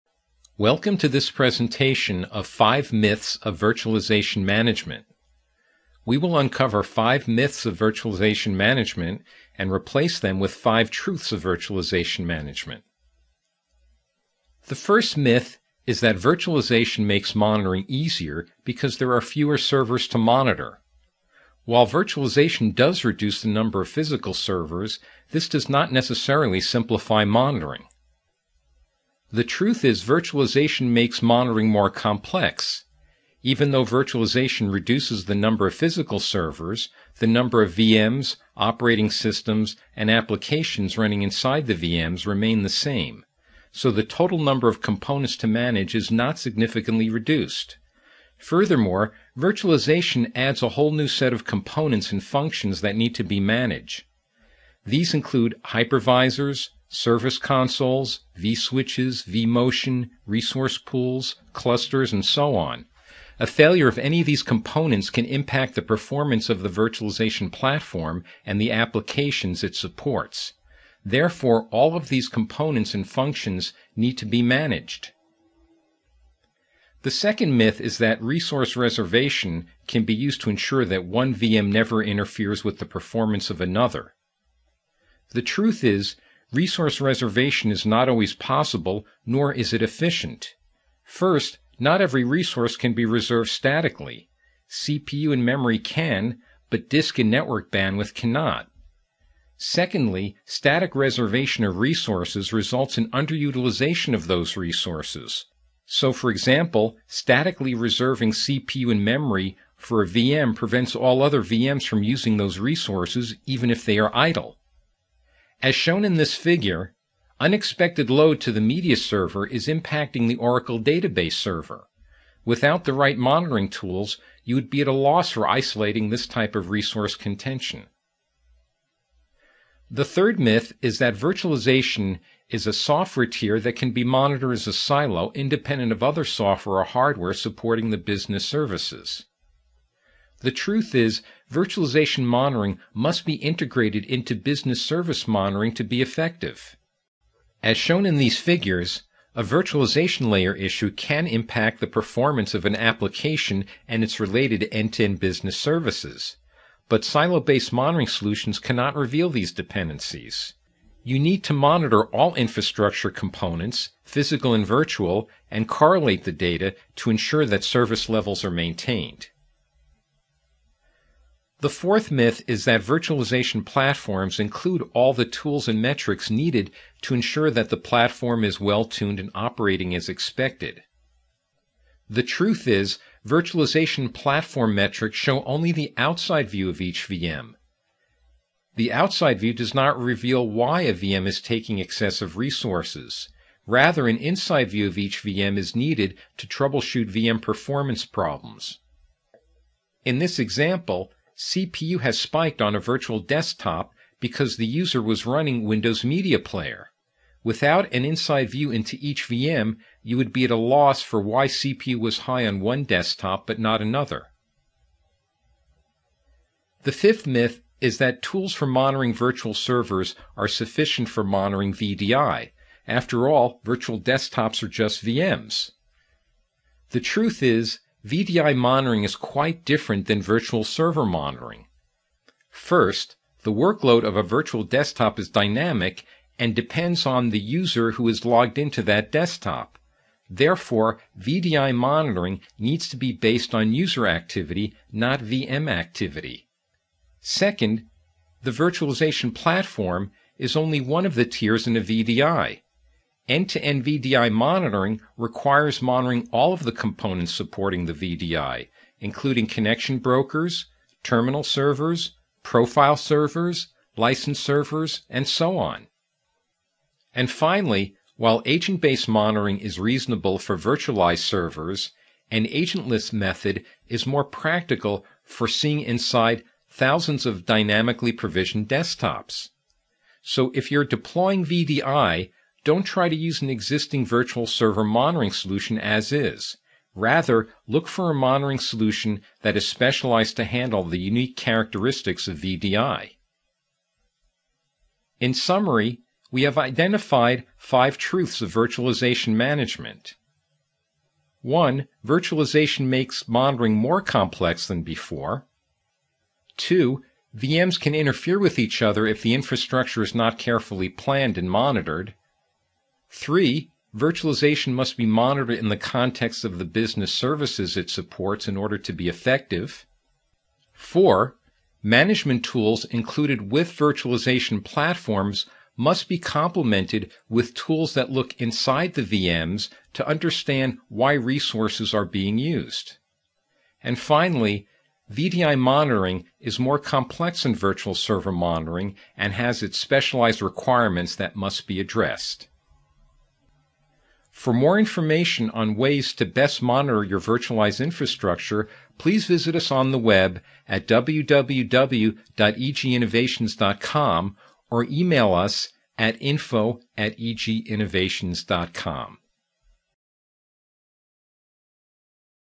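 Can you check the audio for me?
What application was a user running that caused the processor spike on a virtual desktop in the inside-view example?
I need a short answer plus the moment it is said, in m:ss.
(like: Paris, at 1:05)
Windows Media Player, at 3:25.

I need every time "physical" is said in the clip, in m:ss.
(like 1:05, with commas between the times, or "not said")
0:23, 0:35, 2:44.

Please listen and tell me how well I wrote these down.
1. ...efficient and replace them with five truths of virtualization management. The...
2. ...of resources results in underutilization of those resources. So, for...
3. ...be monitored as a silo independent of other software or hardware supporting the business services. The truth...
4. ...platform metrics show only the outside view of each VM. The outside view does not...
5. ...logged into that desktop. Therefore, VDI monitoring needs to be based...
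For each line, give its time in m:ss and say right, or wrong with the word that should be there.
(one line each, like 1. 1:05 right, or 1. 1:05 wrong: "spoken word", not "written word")
1. 0:08 wrong: "management", not "efficient"
2. 1:41 right
3. 2:13 right
4. 3:04 right
5. 3:58 right.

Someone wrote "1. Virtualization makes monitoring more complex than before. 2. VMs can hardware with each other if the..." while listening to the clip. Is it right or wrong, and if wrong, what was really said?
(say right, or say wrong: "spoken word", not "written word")
wrong: "interfere", not "hardware".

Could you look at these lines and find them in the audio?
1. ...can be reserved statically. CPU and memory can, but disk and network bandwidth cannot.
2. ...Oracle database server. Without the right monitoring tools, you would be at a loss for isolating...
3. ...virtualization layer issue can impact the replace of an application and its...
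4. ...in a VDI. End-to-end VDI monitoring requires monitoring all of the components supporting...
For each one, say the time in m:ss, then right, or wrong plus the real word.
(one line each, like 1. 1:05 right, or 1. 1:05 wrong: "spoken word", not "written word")
1. 1:32 right
2. 2:00 right
3. 2:29 wrong: "performance", not "replace"
4. 4:11 right.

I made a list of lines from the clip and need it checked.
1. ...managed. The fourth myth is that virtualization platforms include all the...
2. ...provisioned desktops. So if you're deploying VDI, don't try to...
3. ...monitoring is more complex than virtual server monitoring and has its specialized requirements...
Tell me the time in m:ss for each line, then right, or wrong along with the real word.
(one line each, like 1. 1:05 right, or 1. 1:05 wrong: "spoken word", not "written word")
1. 2:48 wrong: "maintained", not "managed"
2. 4:38 right
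3. 5:35 right.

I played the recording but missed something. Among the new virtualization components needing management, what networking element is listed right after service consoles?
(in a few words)
vSwitches.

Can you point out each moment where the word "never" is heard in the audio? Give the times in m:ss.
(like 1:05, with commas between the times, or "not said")
1:21.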